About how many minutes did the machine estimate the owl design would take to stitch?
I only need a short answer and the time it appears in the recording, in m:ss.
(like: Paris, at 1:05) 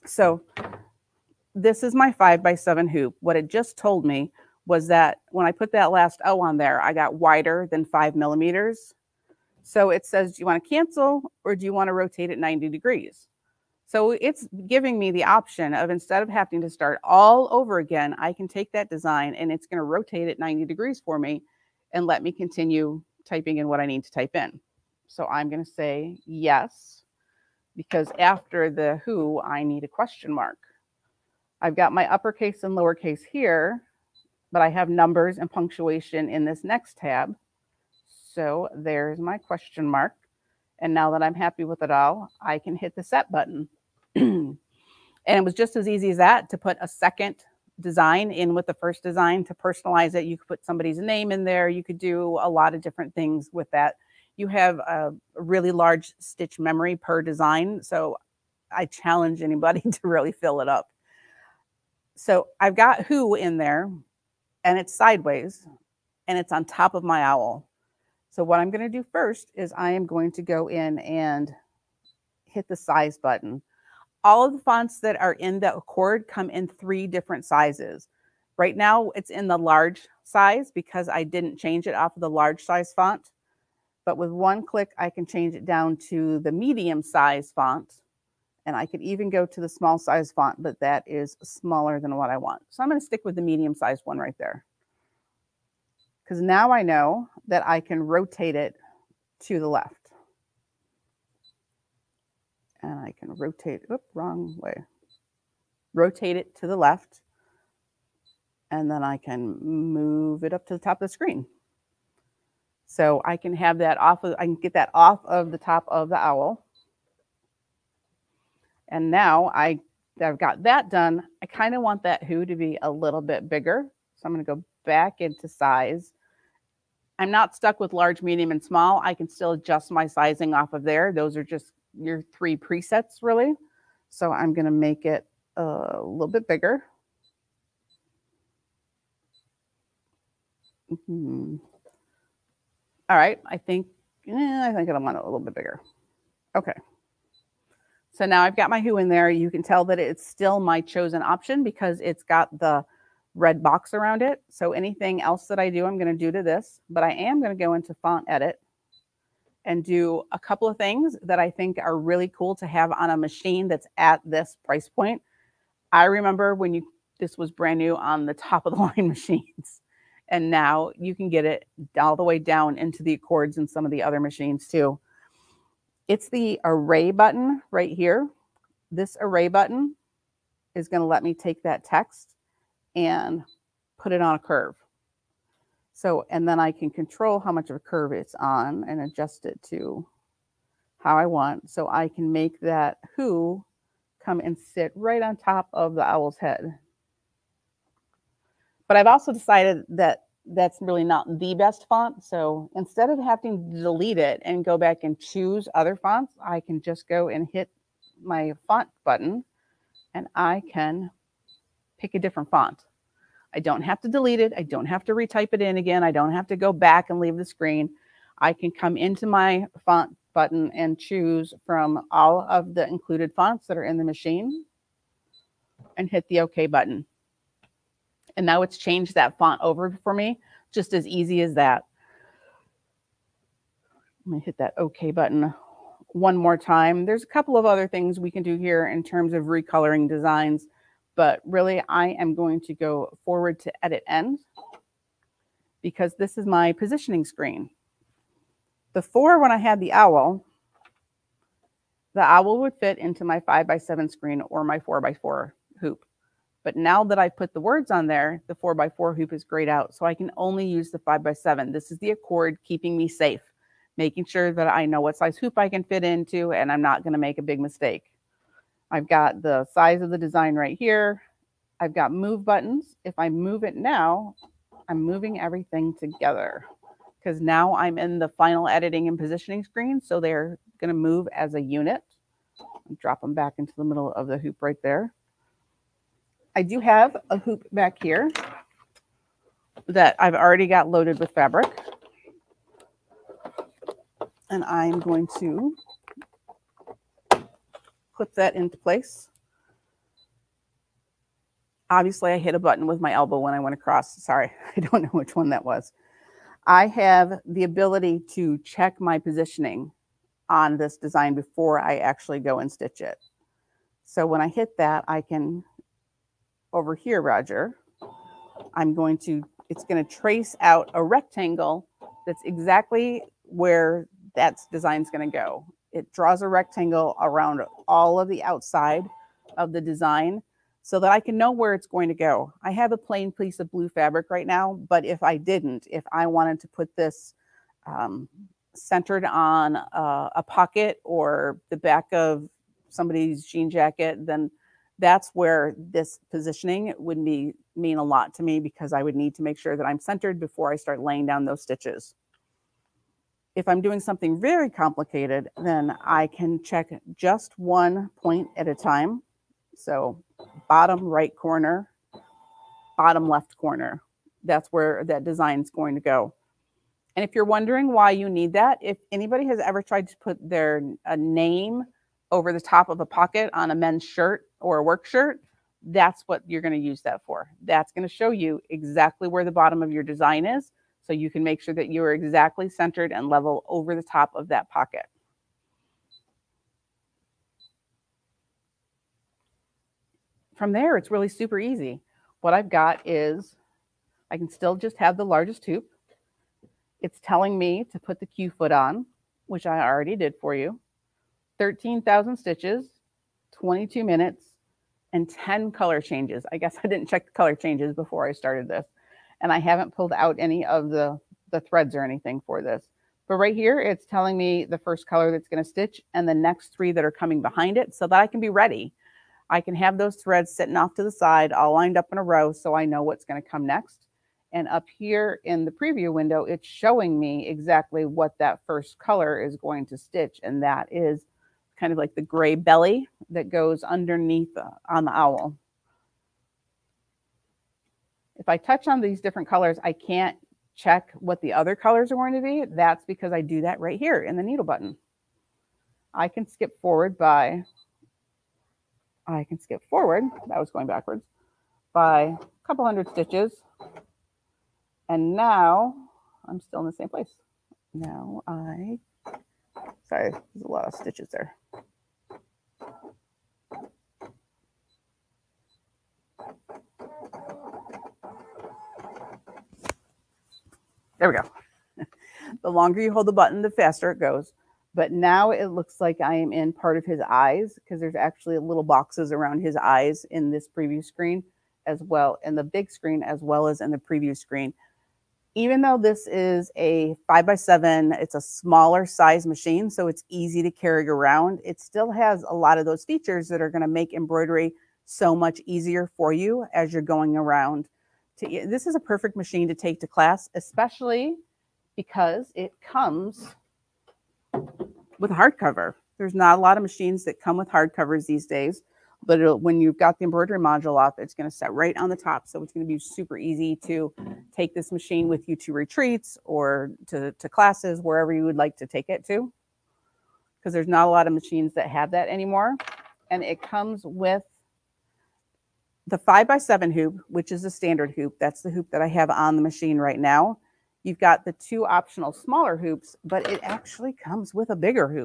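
22, at 6:43.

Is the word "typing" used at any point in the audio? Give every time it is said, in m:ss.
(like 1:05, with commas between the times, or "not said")
0:23.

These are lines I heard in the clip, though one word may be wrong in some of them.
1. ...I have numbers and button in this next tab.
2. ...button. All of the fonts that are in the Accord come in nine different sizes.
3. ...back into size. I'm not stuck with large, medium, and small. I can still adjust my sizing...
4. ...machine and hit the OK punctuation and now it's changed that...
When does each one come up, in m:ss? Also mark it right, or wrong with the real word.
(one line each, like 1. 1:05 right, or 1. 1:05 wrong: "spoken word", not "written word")
1. 0:34 wrong: "punctuation", not "button"
2. 1:13 wrong: "three", not "nine"
3. 2:04 right
4. 3:44 wrong: "button", not "punctuation".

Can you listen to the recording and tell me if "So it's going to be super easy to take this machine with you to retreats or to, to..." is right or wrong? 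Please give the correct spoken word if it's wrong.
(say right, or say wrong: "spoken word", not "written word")
right.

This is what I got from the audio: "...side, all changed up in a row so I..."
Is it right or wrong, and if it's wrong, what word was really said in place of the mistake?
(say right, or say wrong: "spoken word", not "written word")
wrong: "lined", not "changed".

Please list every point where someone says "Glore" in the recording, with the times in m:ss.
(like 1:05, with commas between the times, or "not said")
not said.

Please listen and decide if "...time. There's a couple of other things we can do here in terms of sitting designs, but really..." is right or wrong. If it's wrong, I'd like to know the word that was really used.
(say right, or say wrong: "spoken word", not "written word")
wrong: "recoloring", not "sitting".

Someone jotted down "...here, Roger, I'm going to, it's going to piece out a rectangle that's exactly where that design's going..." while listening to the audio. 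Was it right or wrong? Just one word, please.
wrong.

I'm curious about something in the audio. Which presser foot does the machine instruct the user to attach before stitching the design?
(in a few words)
Q foot.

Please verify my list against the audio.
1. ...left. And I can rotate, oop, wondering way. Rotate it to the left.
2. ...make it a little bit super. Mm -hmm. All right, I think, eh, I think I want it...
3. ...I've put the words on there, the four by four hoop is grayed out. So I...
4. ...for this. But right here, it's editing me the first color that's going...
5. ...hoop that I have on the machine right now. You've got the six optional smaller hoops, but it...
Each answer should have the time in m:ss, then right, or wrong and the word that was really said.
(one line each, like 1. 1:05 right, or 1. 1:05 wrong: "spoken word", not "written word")
1. 1:39 wrong: "wrong", not "wondering"
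2. 2:14 wrong: "bigger", not "super"
3. 4:17 right
4. 6:52 wrong: "telling", not "editing"
5. 8:48 wrong: "two", not "six".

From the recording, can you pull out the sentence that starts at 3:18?
But I've also decided that that's really not the best font.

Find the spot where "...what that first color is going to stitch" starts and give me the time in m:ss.
7:08.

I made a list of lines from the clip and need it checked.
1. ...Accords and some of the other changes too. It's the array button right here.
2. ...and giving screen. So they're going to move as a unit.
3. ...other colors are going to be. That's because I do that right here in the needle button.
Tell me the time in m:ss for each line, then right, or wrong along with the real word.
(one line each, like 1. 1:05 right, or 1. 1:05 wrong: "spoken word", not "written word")
1. 2:53 wrong: "machines", not "changes"
2. 4:39 wrong: "positioning", not "giving"
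3. 7:21 right.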